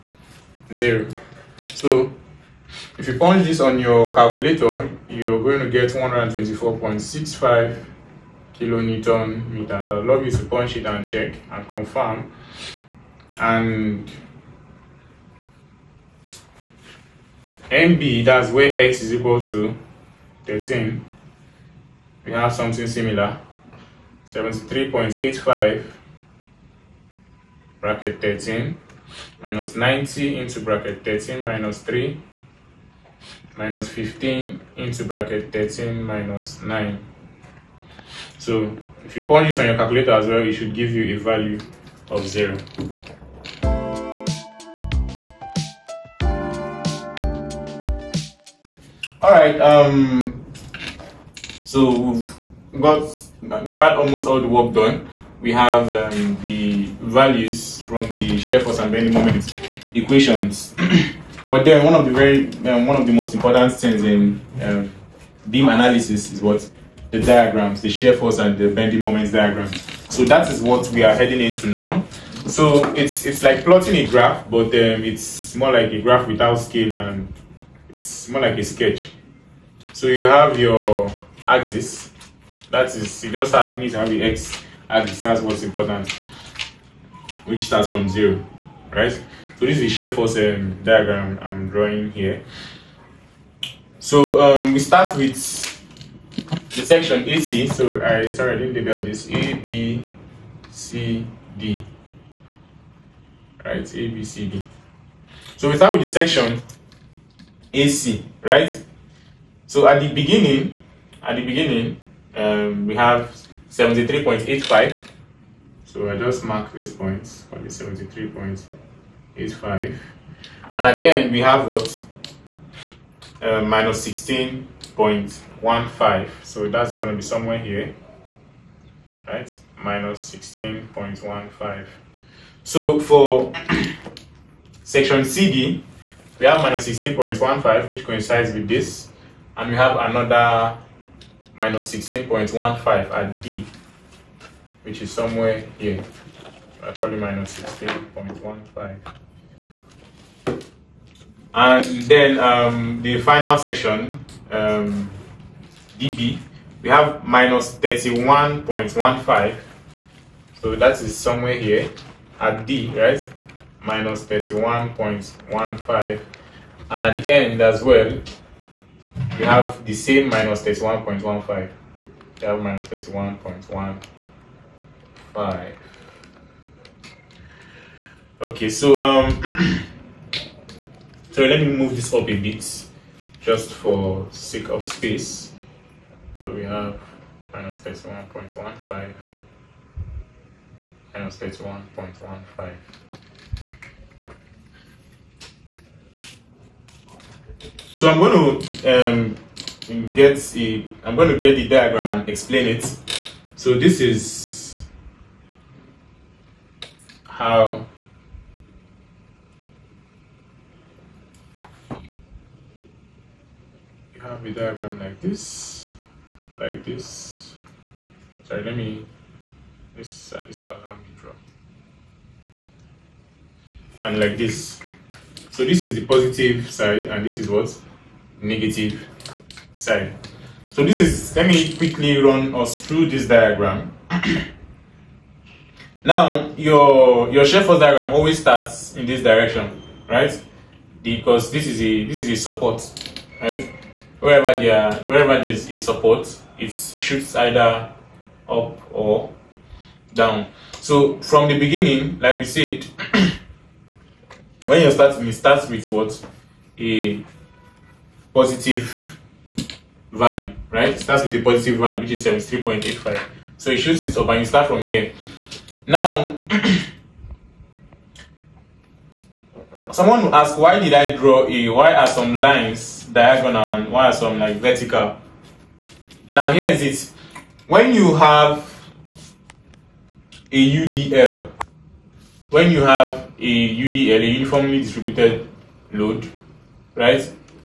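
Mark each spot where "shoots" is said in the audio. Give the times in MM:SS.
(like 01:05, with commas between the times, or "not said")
04:06, 04:23.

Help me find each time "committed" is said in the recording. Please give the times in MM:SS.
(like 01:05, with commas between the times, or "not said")
not said.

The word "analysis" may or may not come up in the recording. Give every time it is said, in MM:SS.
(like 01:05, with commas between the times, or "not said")
01:05.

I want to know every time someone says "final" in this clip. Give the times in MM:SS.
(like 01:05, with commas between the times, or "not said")
02:33.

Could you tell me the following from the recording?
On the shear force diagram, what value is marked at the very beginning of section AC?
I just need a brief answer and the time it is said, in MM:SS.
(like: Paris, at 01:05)
73.85, at 01:53.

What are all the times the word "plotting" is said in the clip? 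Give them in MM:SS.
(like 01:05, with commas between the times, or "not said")
01:13.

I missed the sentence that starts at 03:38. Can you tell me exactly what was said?
Sorry, let me, this, uh, this will allow me draw.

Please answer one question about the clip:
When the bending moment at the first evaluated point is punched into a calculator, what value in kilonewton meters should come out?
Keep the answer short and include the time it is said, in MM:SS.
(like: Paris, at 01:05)
124.65, at 00:05.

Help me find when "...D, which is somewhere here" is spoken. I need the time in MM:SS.
02:23.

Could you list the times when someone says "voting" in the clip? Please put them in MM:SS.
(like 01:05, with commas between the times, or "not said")
not said.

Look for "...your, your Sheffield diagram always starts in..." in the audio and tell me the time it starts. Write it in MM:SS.
03:56.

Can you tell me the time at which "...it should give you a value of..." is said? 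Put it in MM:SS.
00:40.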